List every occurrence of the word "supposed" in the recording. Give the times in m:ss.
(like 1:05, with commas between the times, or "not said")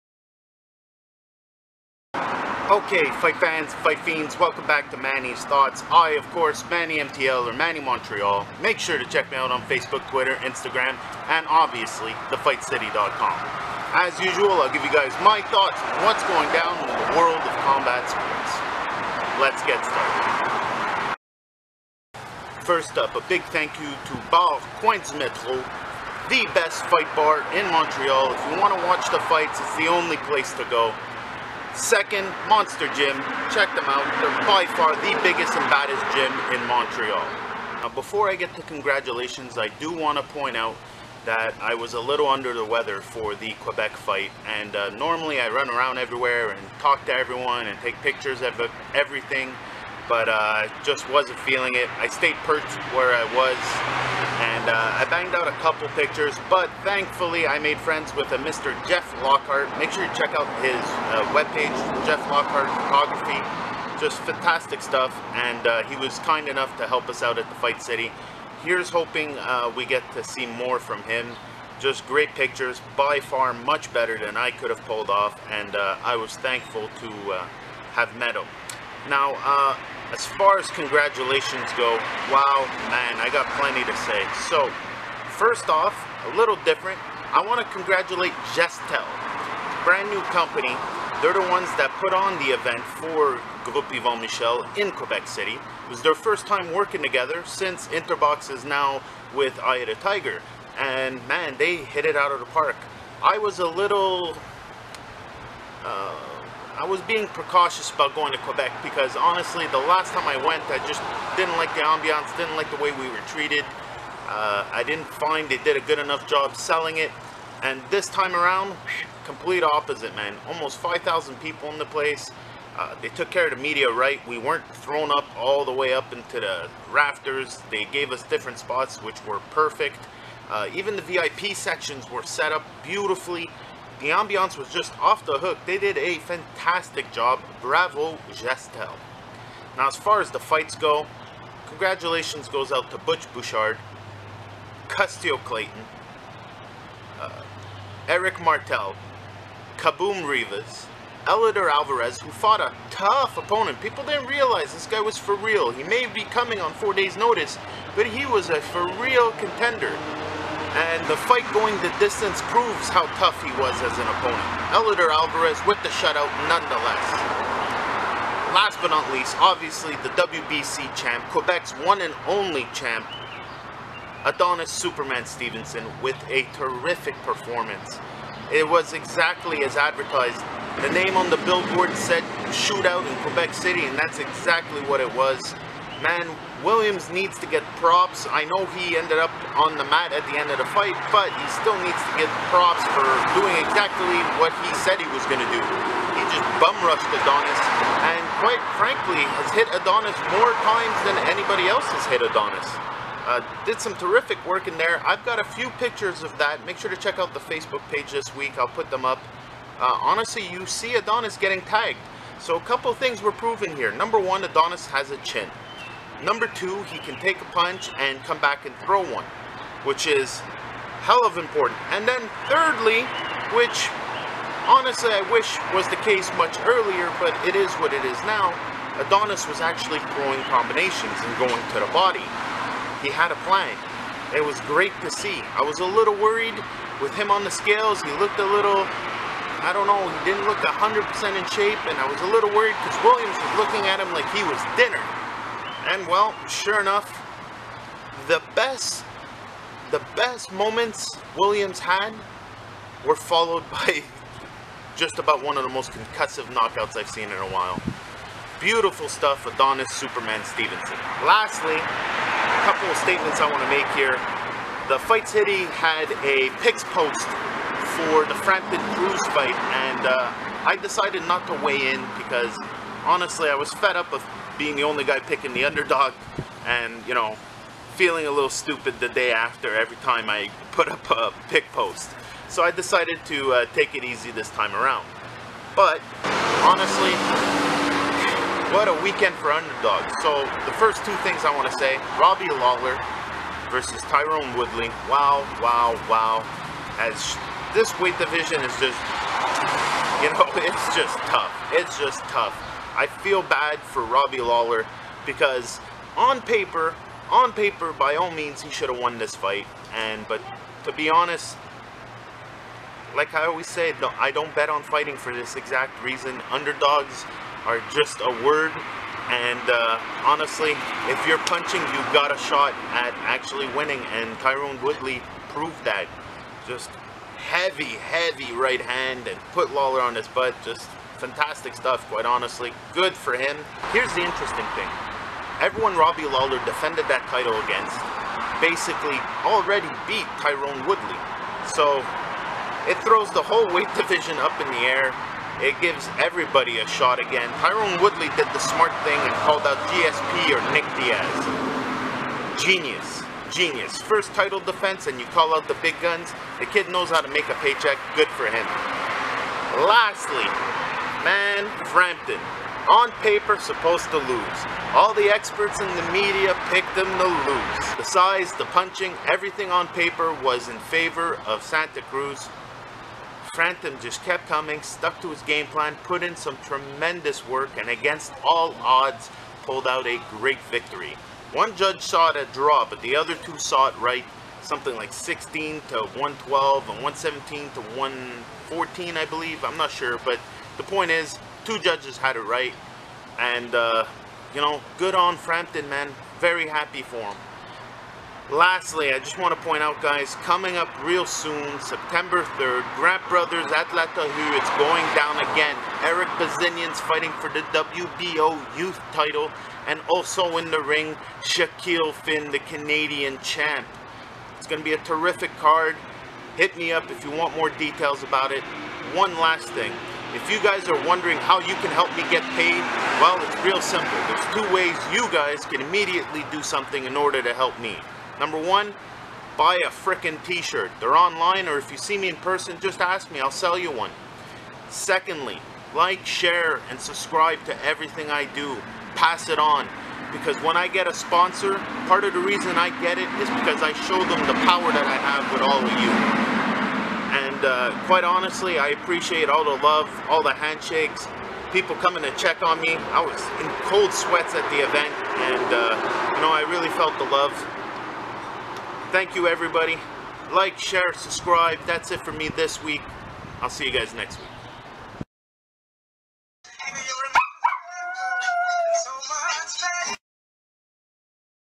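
6:03.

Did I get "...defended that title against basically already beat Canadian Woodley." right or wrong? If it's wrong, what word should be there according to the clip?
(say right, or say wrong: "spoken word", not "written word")
wrong: "Tyron", not "Canadian".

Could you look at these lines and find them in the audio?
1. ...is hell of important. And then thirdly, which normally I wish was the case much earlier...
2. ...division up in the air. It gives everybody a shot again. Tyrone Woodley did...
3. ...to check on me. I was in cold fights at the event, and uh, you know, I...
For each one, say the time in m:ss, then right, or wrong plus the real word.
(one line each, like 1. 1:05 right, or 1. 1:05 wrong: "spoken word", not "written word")
1. 3:40 wrong: "honestly", not "normally"
2. 5:44 right
3. 7:32 wrong: "sweats", not "fights".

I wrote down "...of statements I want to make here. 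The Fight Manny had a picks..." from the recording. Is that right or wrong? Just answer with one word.
wrong.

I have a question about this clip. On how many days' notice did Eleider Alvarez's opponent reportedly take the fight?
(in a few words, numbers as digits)
4.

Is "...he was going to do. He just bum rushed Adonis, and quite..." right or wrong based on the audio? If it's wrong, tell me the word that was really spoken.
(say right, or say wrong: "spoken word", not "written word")
right.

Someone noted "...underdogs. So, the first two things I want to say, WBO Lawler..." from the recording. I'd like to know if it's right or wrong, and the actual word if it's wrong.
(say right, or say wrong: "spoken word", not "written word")
wrong: "Robbie", not "WBO".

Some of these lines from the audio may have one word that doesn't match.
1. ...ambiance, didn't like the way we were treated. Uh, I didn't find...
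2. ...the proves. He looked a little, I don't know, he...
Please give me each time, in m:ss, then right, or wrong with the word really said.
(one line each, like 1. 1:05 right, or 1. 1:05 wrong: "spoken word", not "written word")
1. 1:51 right
2. 3:57 wrong: "scales", not "proves".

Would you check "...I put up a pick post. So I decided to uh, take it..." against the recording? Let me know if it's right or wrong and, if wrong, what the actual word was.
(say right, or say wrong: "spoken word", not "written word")
right.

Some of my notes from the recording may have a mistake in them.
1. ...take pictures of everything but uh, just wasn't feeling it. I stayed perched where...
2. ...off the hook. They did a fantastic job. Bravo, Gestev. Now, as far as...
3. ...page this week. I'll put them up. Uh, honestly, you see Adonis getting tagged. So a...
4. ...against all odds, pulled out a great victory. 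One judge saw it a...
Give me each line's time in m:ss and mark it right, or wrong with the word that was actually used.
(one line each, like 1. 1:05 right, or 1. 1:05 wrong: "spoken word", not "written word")
1. 0:47 right
2. 2:14 right
3. 3:27 right
4. 6:17 right.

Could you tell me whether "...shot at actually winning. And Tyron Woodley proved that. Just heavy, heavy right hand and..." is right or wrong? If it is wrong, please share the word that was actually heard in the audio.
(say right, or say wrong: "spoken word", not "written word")
right.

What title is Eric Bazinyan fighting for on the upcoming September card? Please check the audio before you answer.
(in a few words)
WBO youth title.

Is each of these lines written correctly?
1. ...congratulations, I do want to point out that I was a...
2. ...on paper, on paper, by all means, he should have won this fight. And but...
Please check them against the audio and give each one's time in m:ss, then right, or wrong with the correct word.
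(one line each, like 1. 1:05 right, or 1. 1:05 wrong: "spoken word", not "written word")
1. 0:38 right
2. 5:06 right.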